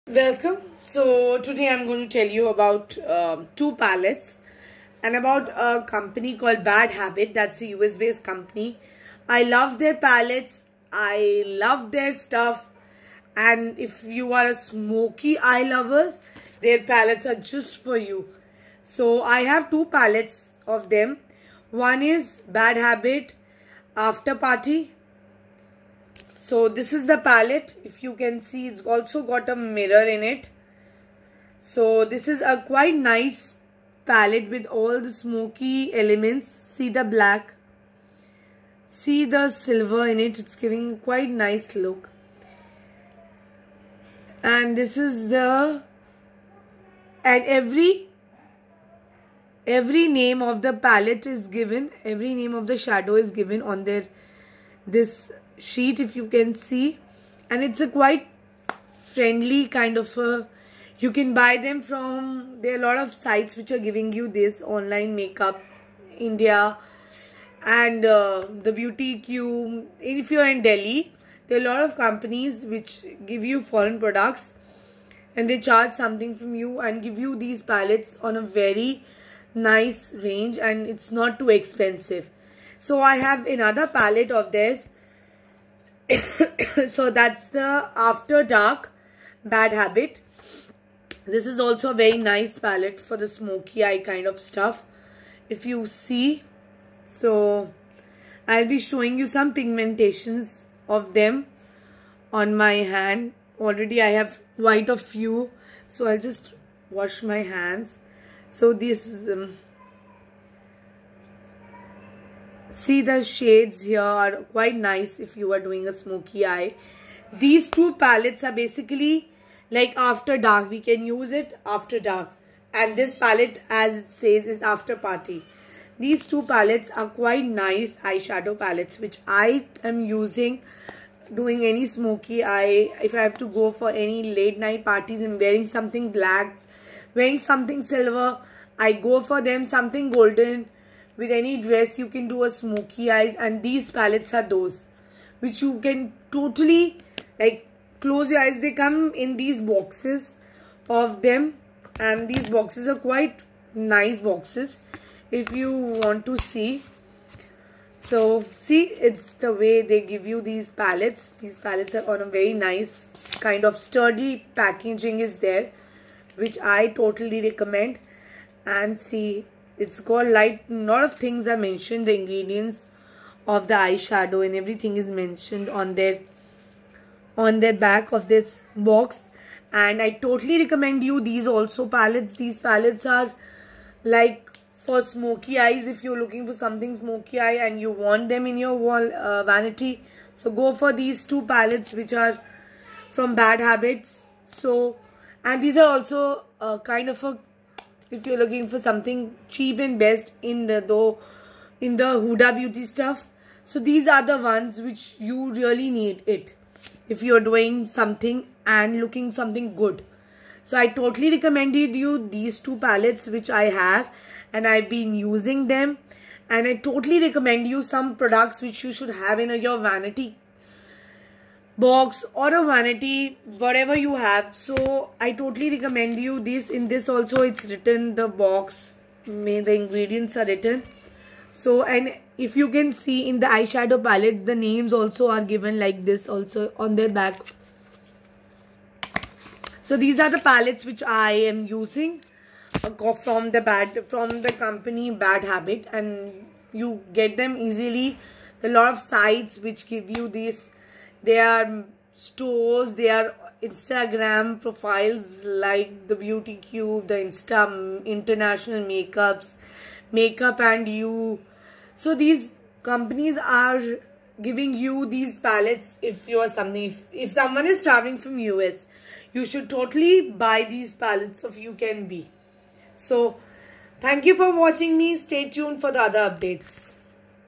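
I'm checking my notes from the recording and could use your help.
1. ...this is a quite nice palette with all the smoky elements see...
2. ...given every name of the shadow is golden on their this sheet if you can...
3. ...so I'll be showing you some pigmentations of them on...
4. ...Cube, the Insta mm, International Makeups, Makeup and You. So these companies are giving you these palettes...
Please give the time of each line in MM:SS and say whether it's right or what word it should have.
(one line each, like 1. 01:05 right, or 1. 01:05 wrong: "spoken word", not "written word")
1. 00:32 right
2. 00:51 wrong: "given", not "golden"
3. 01:37 right
4. 04:16 right.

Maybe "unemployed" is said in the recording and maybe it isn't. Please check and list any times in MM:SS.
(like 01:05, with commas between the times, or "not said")
not said.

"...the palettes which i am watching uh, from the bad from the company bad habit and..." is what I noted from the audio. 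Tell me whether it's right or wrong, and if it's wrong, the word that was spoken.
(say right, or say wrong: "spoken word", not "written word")
wrong: "using", not "watching".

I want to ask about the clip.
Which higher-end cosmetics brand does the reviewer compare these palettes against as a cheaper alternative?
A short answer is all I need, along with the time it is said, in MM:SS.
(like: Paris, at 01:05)
Huda Beauty, at 03:22.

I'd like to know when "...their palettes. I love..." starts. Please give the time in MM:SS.
00:09.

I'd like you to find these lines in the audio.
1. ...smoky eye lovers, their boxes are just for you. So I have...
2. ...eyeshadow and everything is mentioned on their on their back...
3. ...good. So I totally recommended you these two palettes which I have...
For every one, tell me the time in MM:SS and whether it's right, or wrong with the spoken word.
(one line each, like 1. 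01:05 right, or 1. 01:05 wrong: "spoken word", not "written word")
1. 00:14 wrong: "palettes", not "boxes"
2. 02:53 right
3. 03:29 right.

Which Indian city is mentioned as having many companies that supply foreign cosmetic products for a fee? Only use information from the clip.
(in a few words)
Delhi.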